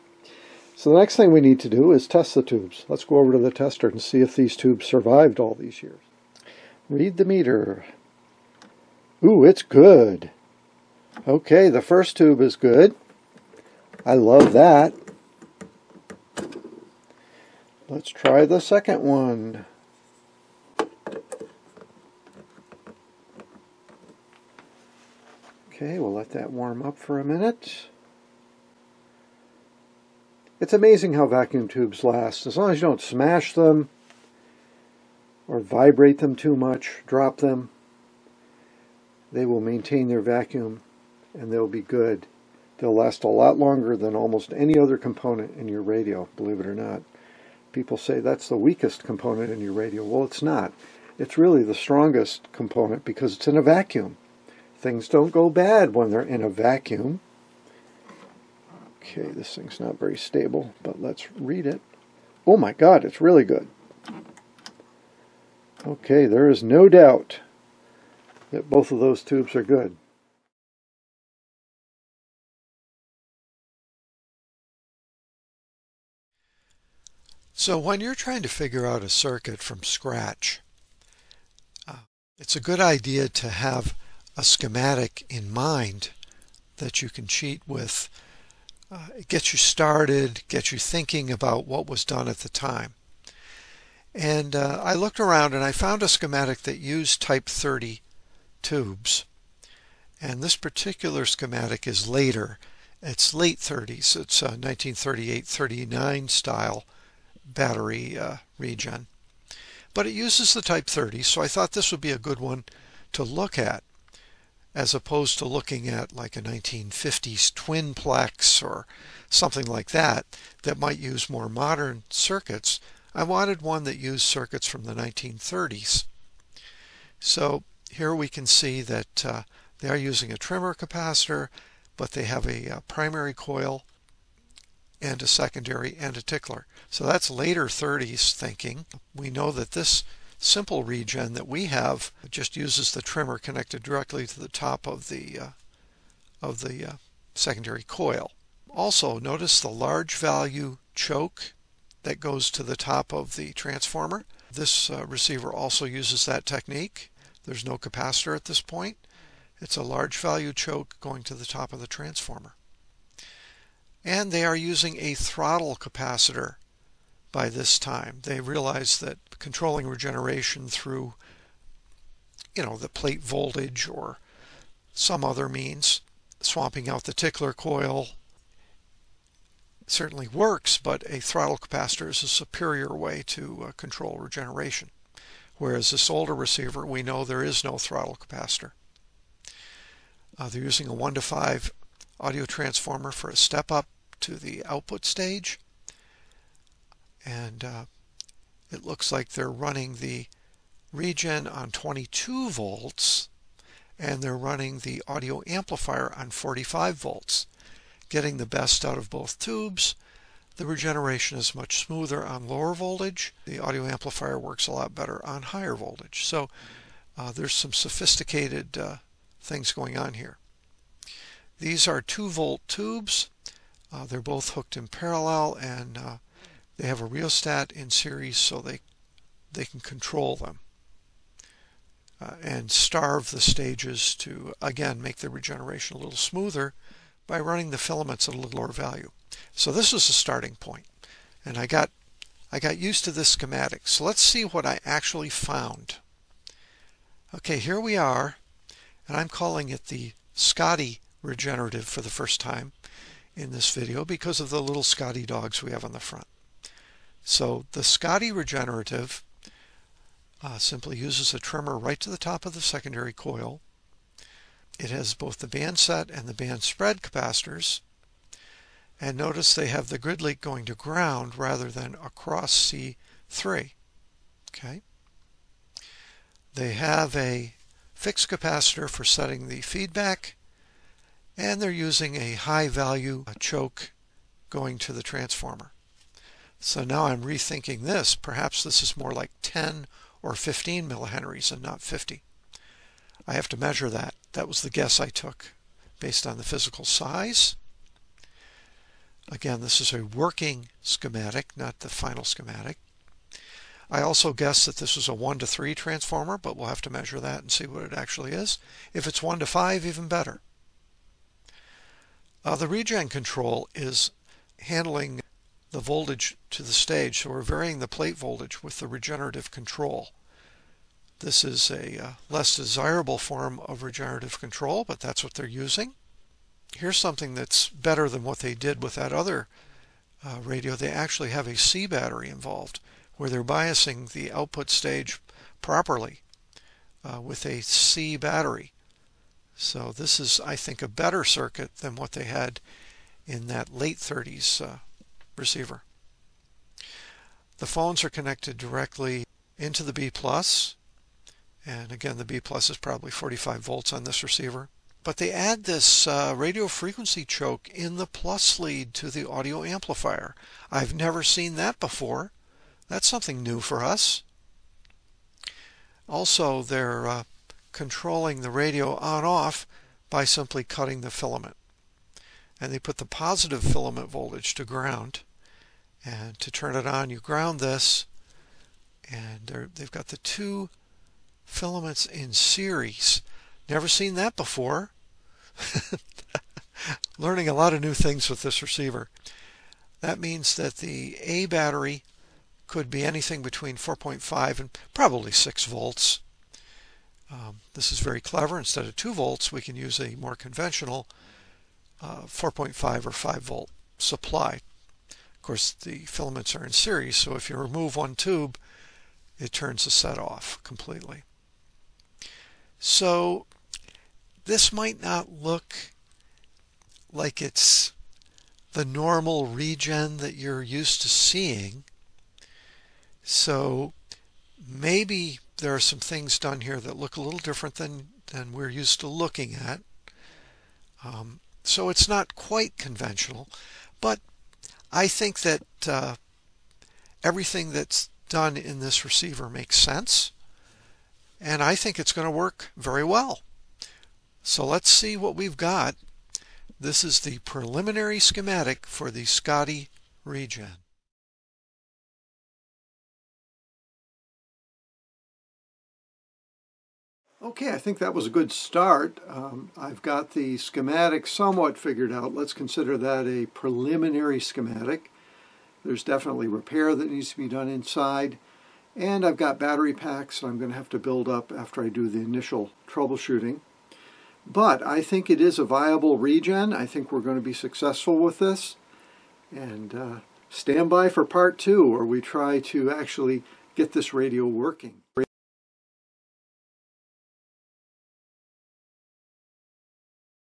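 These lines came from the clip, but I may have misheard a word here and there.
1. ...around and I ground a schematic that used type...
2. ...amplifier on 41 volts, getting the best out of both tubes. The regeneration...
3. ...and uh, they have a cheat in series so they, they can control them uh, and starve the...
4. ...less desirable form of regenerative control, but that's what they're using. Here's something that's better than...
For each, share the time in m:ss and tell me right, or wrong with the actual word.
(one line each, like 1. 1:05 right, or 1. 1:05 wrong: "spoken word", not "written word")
1. 1:35 wrong: "found", not "ground"
2. 3:25 wrong: "45", not "41"
3. 3:45 wrong: "rheostat", not "cheat"
4. 5:22 right.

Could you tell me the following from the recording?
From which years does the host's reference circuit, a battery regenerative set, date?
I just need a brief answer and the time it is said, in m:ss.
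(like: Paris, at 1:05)
1938-39, at 1:44.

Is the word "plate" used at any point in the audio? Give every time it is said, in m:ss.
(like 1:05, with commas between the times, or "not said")
2:52, 5:17.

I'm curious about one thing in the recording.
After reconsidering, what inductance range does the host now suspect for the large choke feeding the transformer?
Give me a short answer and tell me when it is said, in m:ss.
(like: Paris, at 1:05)
10 or 15 millihenries, at 4:49.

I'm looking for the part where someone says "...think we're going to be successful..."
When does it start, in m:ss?
7:56.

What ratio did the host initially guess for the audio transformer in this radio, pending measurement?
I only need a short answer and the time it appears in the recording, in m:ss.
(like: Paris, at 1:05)
1 to 3, at 5:05.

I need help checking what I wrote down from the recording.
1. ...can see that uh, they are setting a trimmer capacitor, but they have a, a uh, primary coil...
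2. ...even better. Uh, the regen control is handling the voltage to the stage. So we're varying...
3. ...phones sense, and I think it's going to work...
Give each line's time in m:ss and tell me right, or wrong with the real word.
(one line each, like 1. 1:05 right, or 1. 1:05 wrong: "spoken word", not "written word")
1. 2:08 wrong: "using", not "setting"
2. 5:09 right
3. 7:19 wrong: "makes", not "phones".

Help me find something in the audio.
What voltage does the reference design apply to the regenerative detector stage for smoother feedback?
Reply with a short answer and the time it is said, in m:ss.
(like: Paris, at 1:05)
22 volts, at 3:21.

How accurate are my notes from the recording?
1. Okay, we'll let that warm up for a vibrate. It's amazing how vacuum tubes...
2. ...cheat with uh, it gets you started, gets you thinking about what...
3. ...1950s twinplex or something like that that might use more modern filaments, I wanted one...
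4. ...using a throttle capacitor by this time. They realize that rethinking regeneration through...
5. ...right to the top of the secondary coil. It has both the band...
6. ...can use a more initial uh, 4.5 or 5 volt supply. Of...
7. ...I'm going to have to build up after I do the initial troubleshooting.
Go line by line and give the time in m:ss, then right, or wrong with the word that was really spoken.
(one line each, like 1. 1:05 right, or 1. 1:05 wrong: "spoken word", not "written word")
1. 0:25 wrong: "minute", not "vibrate"
2. 1:27 right
3. 1:56 wrong: "circuits", not "filaments"
4. 2:44 wrong: "controlling", not "rethinking"
5. 4:21 right
6. 6:39 wrong: "conventional", not "initial"
7. 7:50 right.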